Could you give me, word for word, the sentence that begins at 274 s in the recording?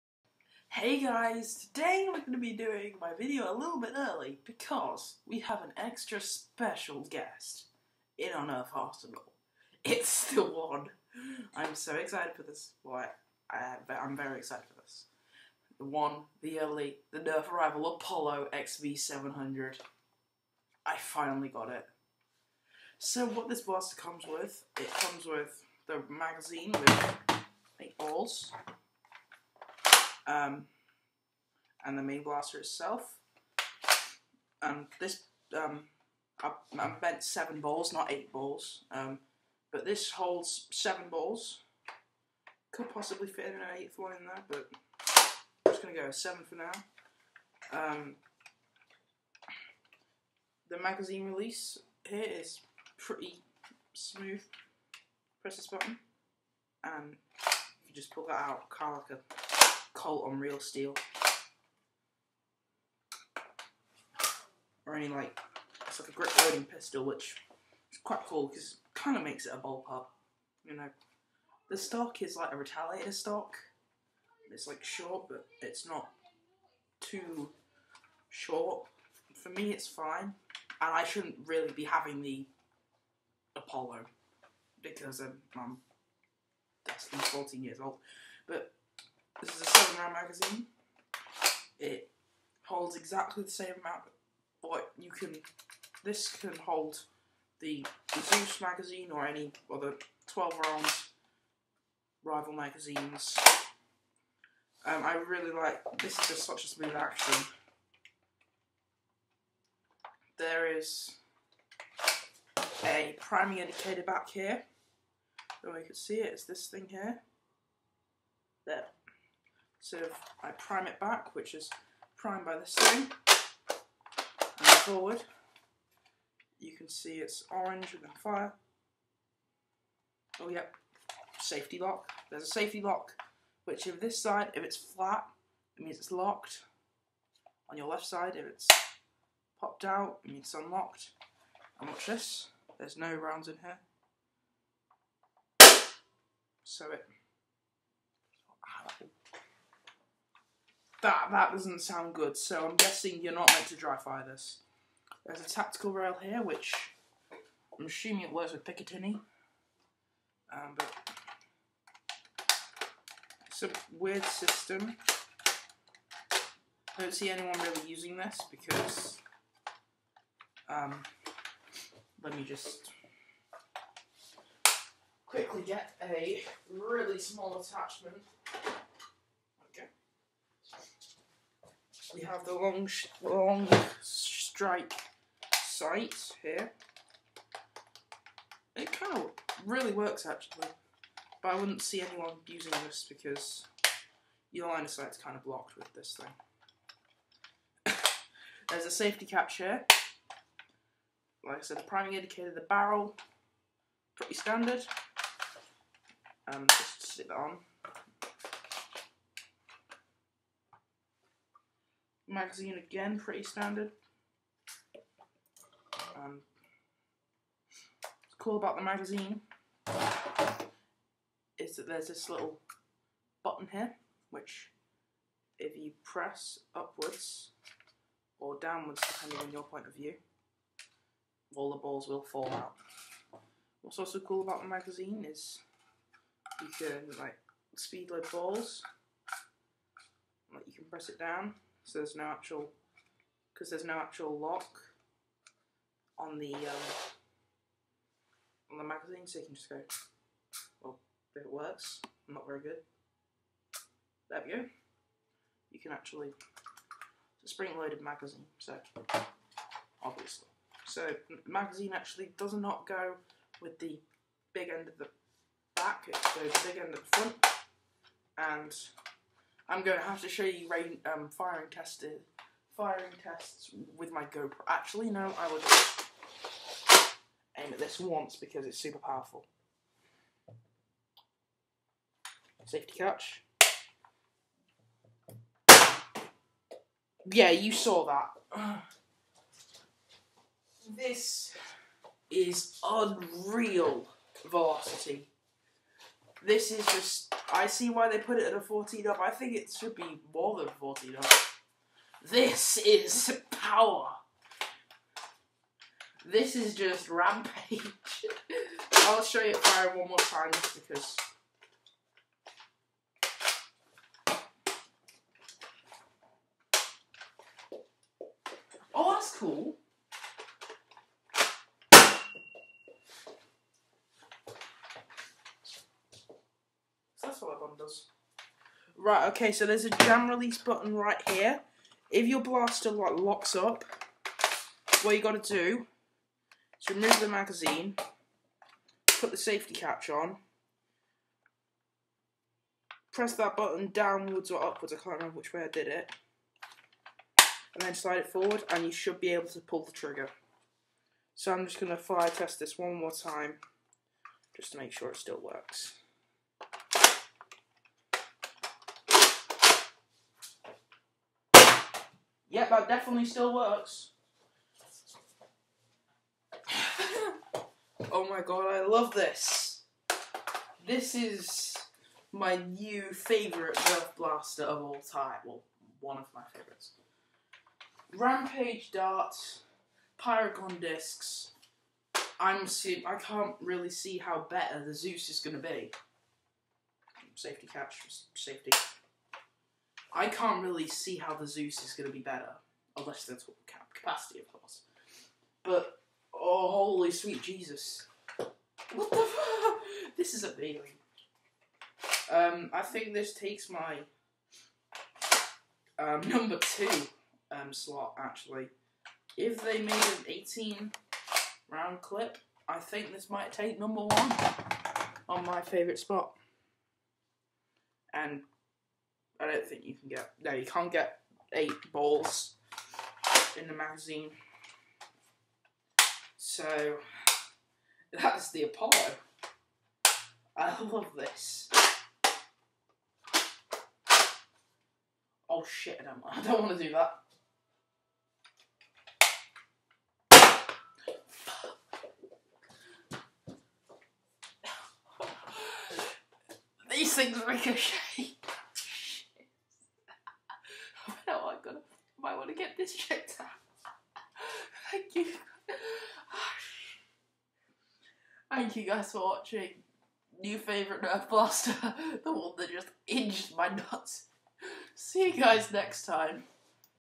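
Actually, no, I will just aim at this once because it's super powerful.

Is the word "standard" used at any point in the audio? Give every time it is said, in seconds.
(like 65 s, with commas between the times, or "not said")
204 s, 213 s.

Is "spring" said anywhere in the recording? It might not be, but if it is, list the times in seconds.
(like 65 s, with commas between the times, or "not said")
257 s.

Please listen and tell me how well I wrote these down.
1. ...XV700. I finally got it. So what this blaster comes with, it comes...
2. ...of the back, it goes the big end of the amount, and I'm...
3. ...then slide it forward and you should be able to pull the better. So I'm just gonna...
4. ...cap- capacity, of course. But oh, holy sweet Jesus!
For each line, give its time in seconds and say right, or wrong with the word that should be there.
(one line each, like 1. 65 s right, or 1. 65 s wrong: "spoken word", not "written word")
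1. 18 s right
2. 264 s wrong: "front", not "amount"
3. 347 s wrong: "trigger", not "better"
4. 393 s right.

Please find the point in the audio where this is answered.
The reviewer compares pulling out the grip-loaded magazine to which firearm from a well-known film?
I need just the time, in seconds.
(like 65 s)
59 s.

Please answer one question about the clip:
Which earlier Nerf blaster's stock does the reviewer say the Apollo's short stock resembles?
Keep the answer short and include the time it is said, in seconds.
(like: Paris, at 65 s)
Retaliator, at 72 s.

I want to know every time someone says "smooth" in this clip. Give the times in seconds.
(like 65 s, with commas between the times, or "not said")
53 s, 106 s.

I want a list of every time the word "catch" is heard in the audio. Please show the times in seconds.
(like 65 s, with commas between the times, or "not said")
199 s, 282 s, 339 s, 387 s.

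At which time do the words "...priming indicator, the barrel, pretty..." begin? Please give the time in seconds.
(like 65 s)
201 s.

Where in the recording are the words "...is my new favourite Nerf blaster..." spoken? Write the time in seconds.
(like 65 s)
371 s.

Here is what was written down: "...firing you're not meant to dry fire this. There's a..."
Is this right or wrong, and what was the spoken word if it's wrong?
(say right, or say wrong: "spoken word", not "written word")
wrong: "guessing", not "firing".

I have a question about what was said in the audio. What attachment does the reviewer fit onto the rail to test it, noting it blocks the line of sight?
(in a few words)
Long strike sight.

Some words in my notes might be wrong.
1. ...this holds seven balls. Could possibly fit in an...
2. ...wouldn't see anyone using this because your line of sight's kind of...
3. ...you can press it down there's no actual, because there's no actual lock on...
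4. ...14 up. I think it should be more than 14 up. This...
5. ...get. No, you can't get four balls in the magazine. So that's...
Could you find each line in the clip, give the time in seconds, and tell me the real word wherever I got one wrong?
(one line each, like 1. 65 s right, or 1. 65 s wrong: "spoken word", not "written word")
1. 39 s right
2. 191 s right
3. 240 s right
4. 298 s right
5. 420 s wrong: "eight", not "four".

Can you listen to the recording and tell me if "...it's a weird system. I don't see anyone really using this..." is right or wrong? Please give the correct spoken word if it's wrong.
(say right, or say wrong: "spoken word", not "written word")
right.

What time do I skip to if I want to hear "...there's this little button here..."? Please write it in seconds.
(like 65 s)
221 s.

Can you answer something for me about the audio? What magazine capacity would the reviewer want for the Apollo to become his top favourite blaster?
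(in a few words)
18 rounds.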